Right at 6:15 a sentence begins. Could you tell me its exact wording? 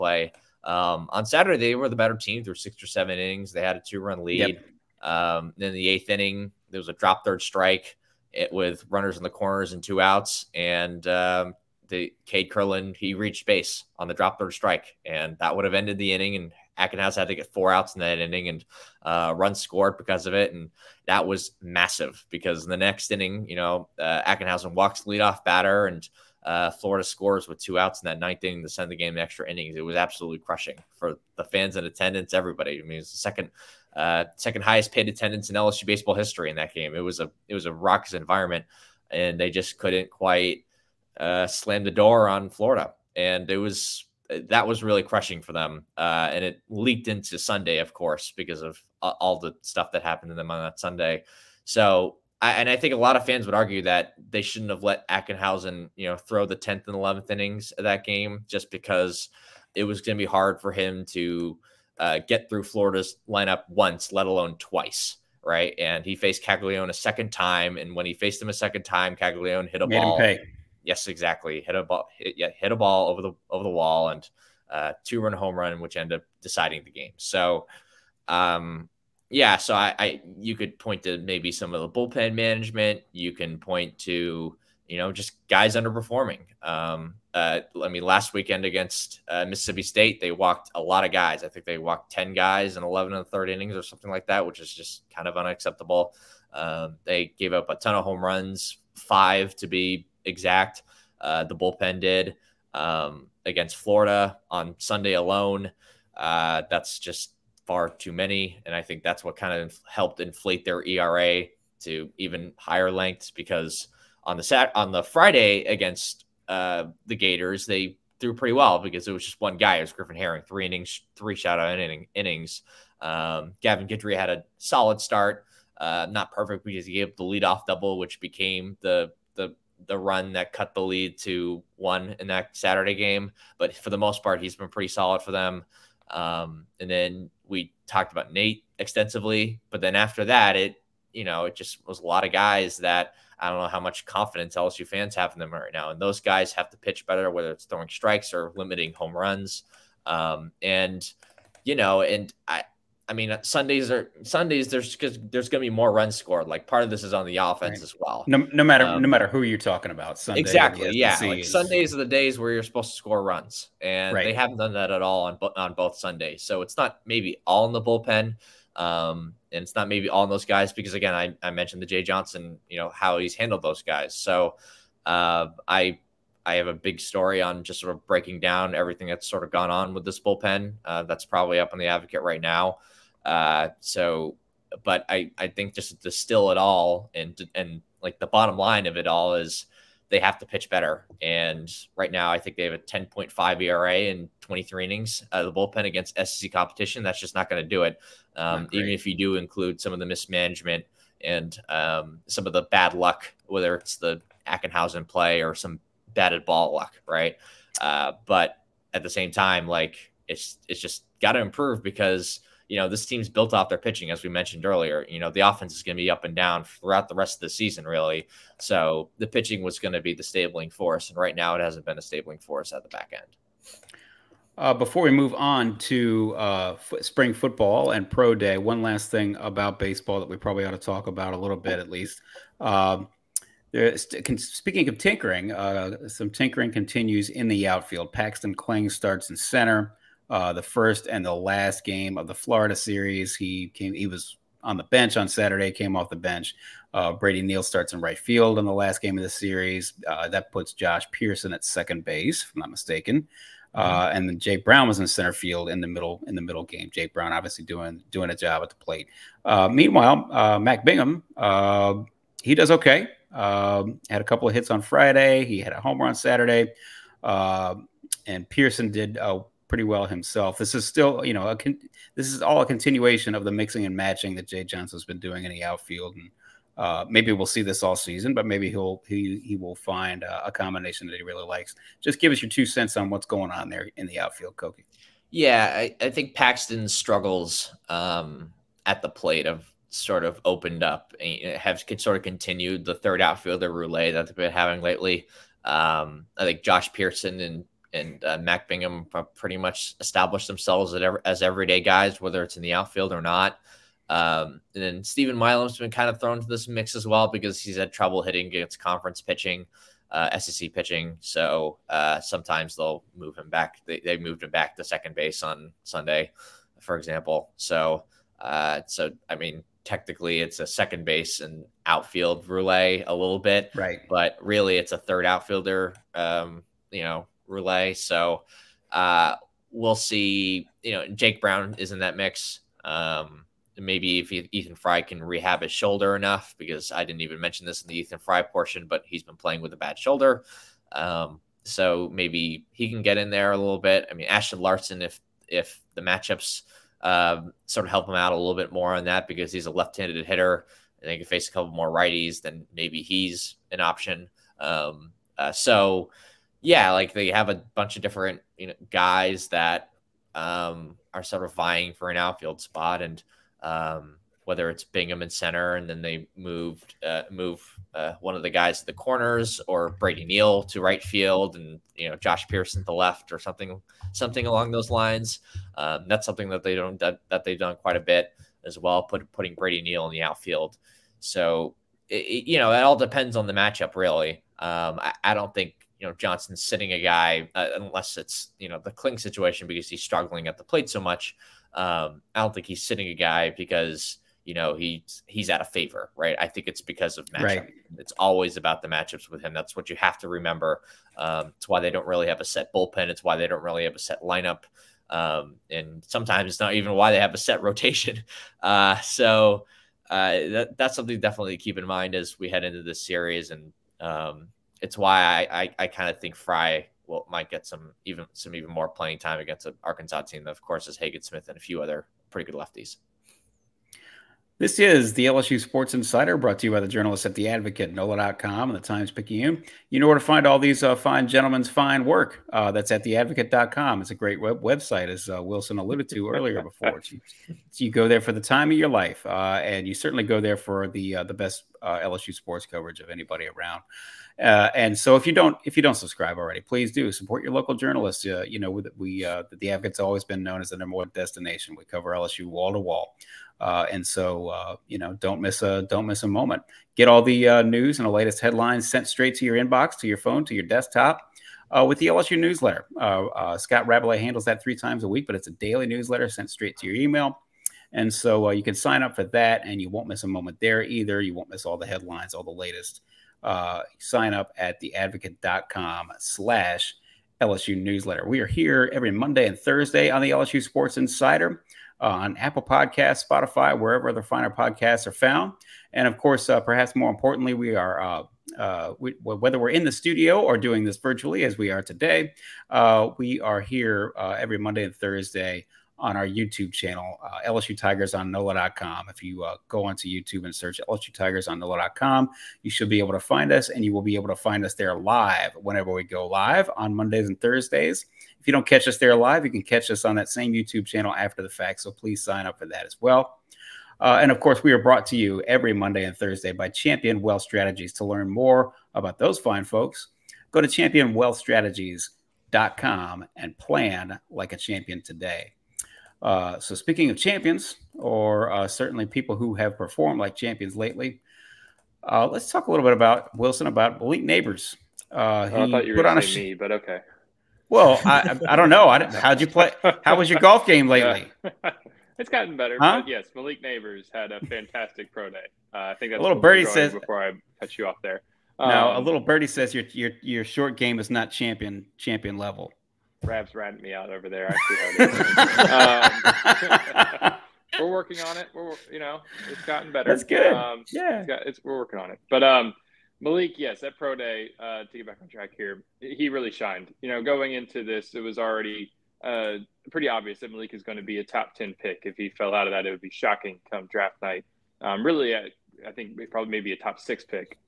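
Um, that's something that they don't that, that they've done quite a bit as well, put, putting Brady Neal in the outfield.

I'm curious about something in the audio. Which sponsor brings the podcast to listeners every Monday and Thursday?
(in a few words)
Champion Wealth Strategies.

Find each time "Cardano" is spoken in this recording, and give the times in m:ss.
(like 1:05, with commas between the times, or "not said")
not said.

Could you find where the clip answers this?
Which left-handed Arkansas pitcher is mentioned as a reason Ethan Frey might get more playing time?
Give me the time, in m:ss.
7:00.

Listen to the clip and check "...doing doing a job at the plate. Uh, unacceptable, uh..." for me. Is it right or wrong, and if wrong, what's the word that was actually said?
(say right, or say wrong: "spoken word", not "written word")
wrong: "meanwhile", not "unacceptable".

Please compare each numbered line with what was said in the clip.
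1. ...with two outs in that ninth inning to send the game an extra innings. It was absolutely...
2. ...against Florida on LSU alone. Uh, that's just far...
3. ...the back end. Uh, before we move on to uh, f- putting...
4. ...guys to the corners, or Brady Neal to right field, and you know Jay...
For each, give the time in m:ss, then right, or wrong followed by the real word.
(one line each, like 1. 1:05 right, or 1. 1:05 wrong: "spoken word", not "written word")
1. 0:27 right
2. 1:43 wrong: "Sunday", not "LSU"
3. 3:42 wrong: "spring", not "putting"
4. 6:08 wrong: "Josh", not "Jay".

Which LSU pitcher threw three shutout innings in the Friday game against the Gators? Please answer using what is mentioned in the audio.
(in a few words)
Griffin Herring.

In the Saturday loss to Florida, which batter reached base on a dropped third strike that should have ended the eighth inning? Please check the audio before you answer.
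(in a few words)
Cade Kurland.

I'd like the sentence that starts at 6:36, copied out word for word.
I think it's because of matchup.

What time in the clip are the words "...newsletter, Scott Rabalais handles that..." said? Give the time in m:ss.
7:42.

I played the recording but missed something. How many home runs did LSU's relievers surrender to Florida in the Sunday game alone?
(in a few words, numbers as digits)
5.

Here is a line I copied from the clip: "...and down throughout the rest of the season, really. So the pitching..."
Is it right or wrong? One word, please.
right.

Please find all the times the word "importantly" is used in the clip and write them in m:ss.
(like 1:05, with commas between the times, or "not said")
8:07.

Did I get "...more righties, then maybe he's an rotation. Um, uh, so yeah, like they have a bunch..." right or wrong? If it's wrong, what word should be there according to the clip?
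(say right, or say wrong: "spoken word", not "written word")
wrong: "option", not "rotation".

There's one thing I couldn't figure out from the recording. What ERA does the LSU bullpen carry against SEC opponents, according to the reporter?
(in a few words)
10.5.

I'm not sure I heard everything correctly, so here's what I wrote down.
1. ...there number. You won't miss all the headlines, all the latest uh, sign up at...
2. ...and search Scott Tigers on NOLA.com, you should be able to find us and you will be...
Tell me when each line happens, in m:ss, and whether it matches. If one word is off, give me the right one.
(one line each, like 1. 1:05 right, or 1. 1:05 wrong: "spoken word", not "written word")
1. 7:50 wrong: "either", not "number"
2. 8:20 wrong: "LSU", not "Scott".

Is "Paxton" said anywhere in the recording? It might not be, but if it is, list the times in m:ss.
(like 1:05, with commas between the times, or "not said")
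3:58, 4:46.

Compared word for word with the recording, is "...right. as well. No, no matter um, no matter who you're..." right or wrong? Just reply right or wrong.
right.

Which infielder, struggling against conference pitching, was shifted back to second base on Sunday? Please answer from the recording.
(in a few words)
Steven Milam.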